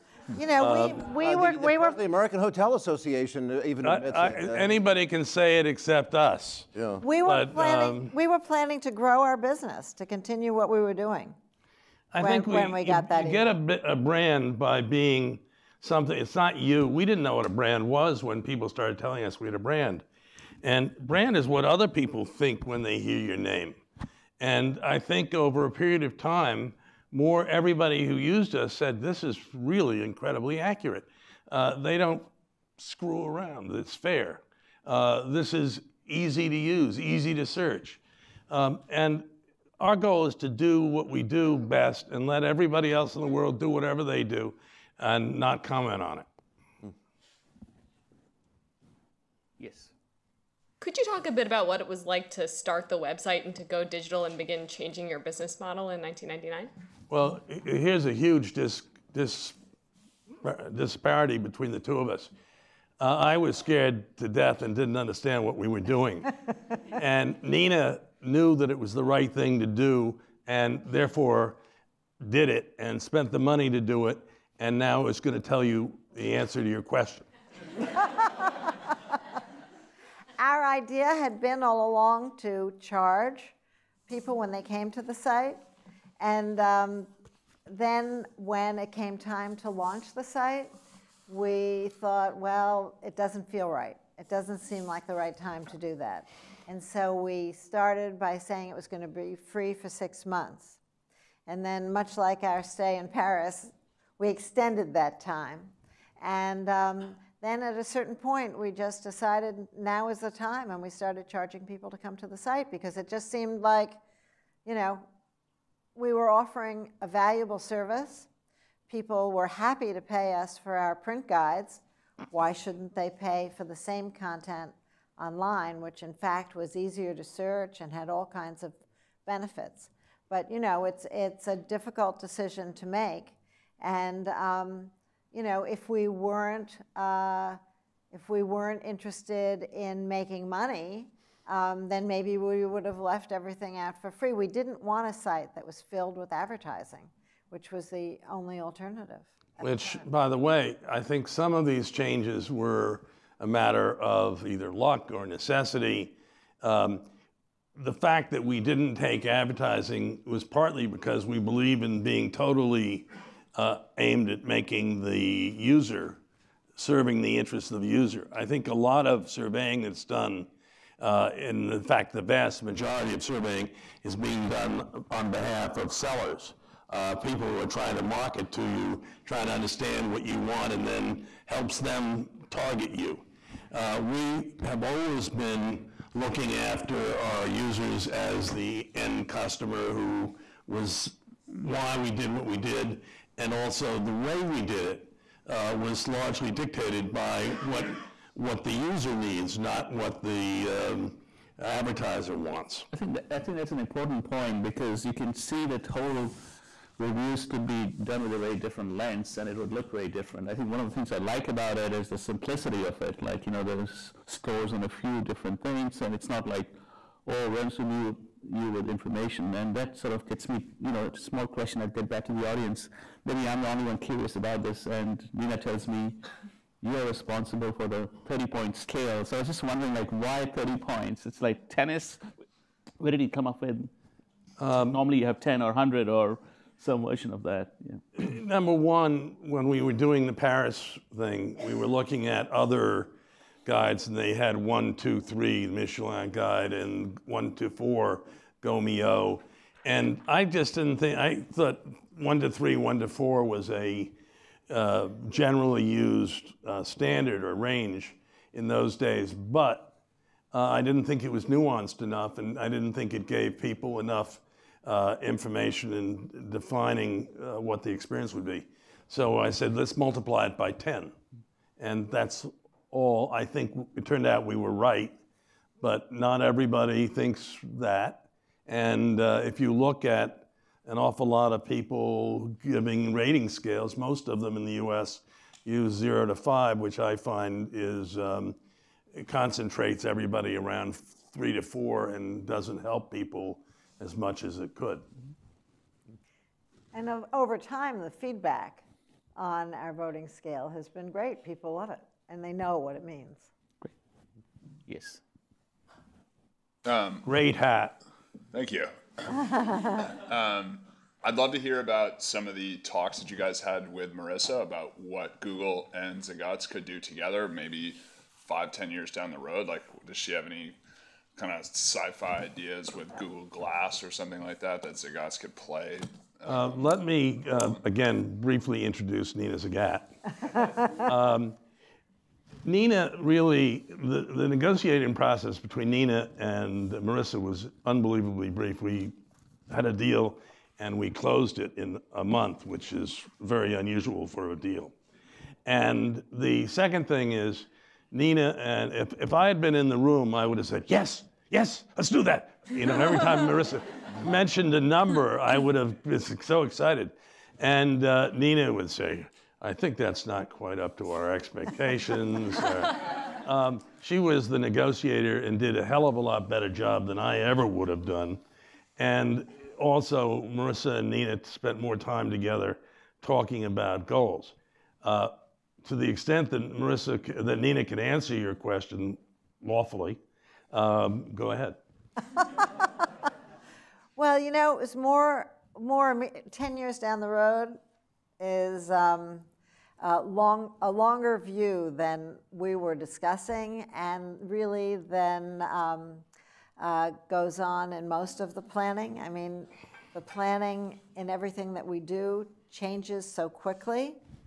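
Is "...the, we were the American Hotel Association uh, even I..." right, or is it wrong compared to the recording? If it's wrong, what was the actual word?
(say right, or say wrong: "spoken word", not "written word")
right.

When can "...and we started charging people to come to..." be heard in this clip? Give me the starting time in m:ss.
1:50.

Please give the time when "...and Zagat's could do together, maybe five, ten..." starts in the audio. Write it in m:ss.
5:15.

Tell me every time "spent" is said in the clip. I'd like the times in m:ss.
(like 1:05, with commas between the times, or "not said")
1:13, 6:11.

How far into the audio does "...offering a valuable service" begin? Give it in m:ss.
1:56.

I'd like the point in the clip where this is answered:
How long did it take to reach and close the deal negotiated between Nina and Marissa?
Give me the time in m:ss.
5:42.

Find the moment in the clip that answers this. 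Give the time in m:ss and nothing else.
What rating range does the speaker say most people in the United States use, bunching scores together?
4:45.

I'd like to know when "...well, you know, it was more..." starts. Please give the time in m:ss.
6:24.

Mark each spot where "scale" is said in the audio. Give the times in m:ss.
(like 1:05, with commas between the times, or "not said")
3:48, 4:43, 5:00.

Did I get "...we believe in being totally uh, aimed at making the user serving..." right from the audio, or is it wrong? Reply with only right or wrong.
right.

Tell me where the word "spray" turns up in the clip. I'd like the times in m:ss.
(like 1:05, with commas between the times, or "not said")
not said.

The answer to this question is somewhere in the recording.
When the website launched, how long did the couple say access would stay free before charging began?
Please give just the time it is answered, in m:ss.
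1:39.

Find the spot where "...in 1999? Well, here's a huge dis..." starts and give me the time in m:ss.
0:55.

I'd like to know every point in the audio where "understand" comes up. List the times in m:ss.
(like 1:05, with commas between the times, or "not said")
1:04, 2:59.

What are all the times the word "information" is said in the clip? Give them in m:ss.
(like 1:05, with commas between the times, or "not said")
3:38, 4:25.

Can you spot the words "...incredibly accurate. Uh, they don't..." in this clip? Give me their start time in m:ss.
0:30.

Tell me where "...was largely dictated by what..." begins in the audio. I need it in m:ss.
3:15.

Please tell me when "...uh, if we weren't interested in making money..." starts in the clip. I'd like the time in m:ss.
2:16.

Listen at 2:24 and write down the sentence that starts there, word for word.
We didn't want a site that was filled with advertising, which was the only alternative.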